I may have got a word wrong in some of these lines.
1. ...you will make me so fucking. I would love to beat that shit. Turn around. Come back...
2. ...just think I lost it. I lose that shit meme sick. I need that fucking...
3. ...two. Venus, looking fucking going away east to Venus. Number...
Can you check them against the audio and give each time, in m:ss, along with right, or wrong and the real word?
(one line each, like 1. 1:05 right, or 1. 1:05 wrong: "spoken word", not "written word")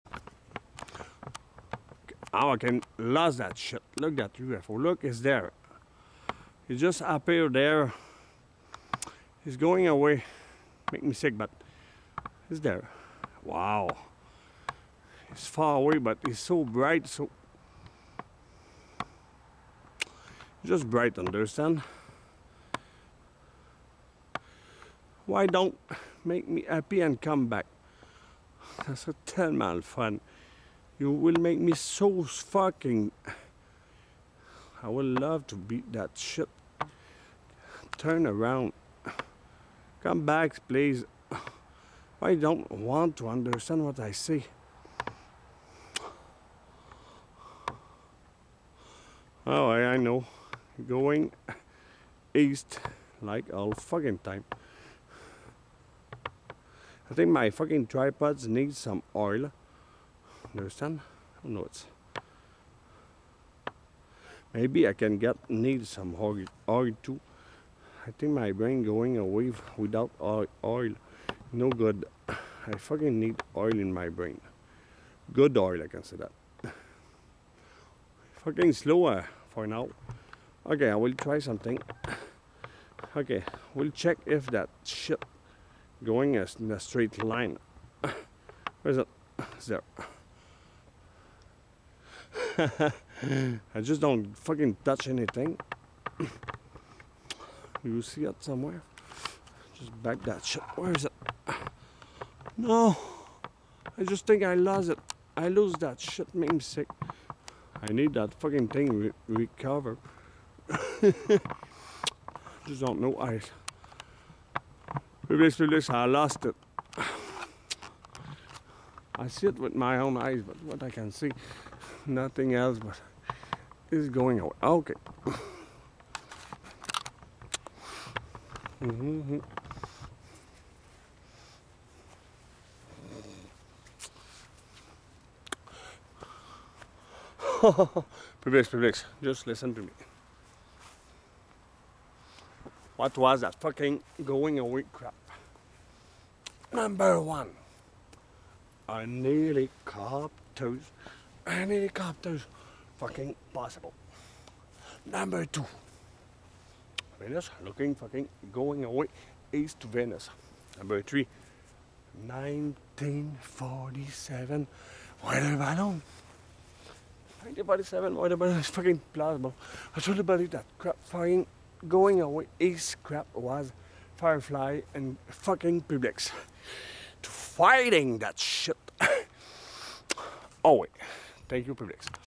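1. 0:31 right
2. 1:44 right
3. 2:35 right.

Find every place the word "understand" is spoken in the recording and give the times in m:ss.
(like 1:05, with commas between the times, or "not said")
0:21, 0:43.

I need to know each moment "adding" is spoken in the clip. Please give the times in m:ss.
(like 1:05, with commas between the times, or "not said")
not said.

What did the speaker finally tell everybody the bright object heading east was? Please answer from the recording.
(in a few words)
Firefly.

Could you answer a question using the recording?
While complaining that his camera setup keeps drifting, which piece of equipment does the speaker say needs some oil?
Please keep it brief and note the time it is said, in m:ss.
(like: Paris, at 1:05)
tripods, at 0:57.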